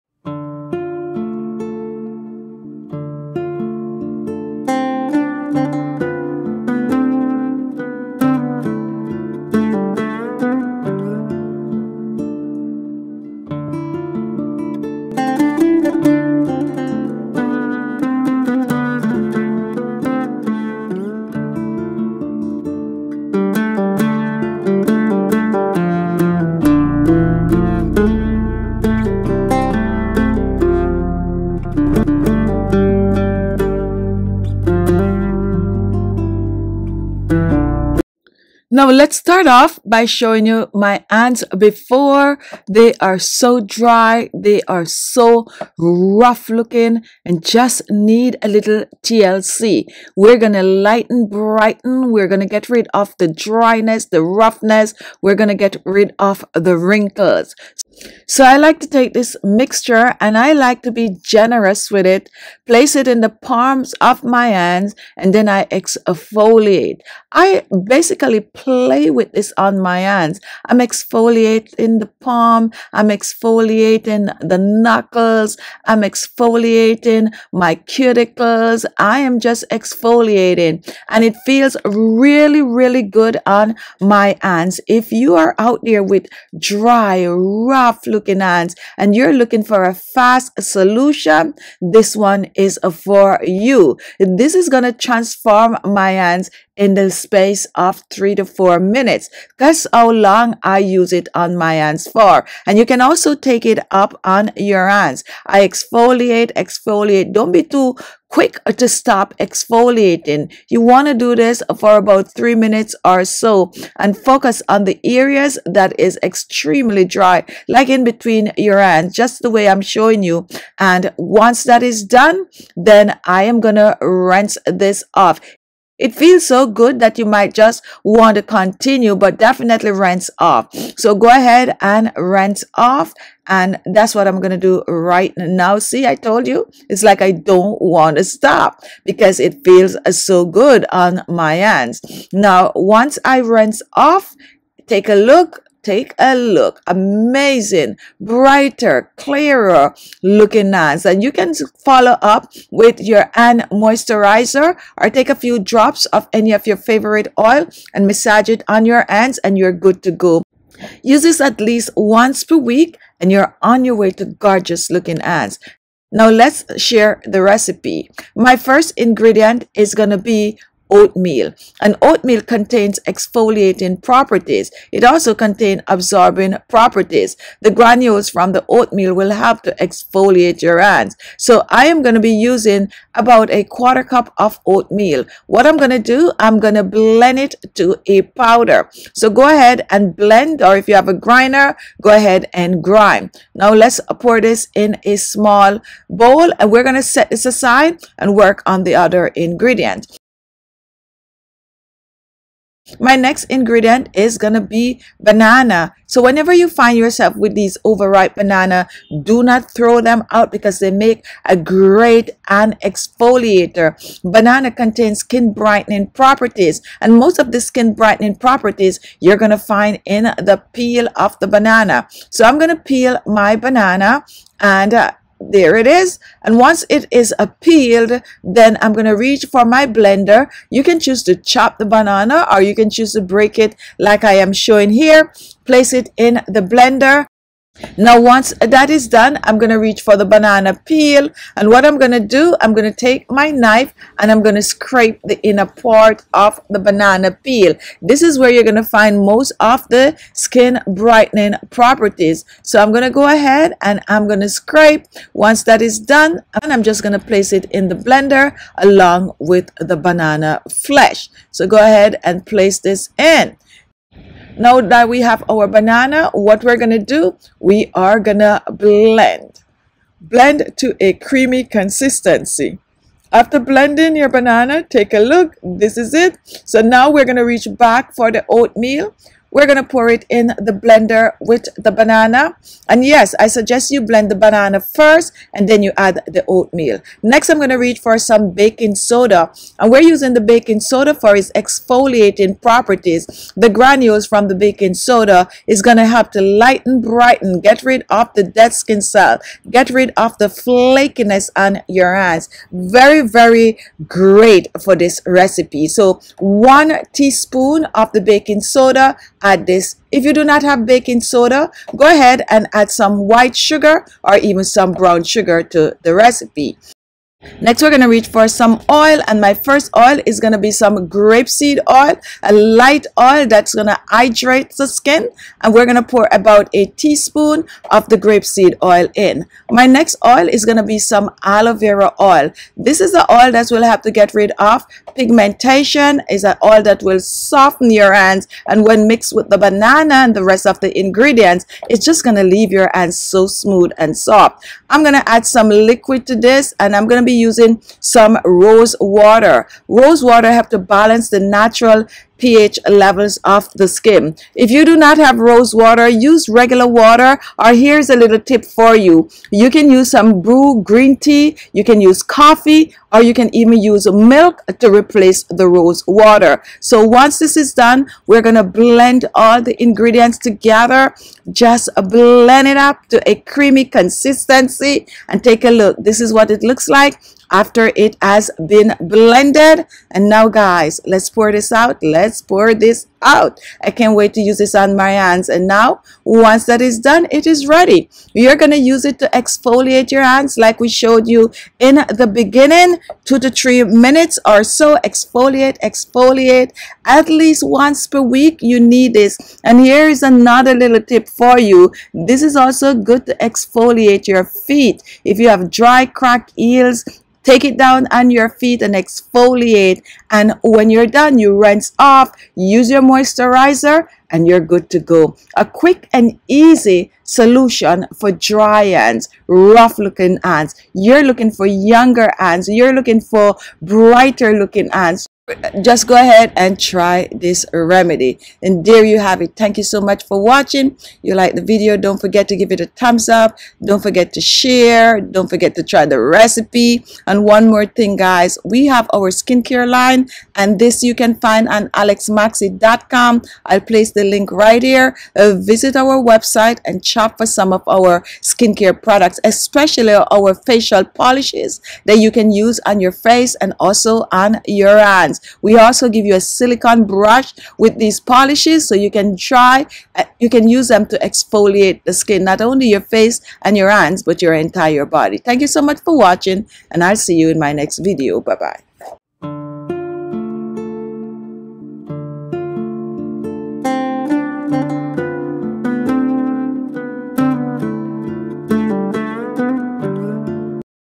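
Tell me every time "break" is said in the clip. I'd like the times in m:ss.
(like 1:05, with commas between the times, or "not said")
3:53.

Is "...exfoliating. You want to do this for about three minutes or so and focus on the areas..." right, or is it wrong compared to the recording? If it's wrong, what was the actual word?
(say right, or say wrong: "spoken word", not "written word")
right.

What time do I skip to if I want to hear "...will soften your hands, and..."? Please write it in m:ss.
5:37.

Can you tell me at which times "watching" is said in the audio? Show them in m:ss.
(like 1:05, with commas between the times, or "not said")
7:10, 7:46.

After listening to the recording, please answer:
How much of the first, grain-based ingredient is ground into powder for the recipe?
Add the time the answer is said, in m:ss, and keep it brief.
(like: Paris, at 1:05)
a quarter cup, at 3:03.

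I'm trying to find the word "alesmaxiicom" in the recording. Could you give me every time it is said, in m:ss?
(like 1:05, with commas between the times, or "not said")
7:21.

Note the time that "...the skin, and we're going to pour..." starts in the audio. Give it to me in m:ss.
5:24.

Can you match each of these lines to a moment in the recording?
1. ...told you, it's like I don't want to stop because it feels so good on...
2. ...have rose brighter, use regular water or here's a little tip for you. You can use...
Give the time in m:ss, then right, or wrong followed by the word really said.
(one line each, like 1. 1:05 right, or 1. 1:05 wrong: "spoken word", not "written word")
1. 2:16 right
2. 5:55 wrong: "water", not "brighter".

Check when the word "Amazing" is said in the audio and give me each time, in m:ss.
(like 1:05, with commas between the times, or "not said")
2:26.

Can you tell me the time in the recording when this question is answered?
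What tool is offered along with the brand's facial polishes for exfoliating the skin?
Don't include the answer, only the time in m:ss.
7:36.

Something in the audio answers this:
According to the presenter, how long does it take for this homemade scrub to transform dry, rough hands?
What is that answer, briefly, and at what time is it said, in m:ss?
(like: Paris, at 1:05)
3 to 4 minutes, at 1:38.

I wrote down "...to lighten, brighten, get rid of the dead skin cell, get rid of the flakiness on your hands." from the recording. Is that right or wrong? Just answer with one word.
right.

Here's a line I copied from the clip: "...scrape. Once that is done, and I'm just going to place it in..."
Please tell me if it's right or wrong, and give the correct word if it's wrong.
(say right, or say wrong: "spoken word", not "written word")
right.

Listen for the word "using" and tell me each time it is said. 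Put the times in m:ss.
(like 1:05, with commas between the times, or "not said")
3:02, 4:50, 5:47.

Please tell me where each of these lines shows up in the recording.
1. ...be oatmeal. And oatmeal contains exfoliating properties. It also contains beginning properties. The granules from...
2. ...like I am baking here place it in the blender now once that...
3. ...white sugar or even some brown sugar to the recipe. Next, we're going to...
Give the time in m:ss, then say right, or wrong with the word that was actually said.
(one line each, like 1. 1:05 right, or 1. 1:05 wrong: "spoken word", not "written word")
1. 2:50 wrong: "absorbing", not "beginning"
2. 3:53 wrong: "showing", not "baking"
3. 5:13 right.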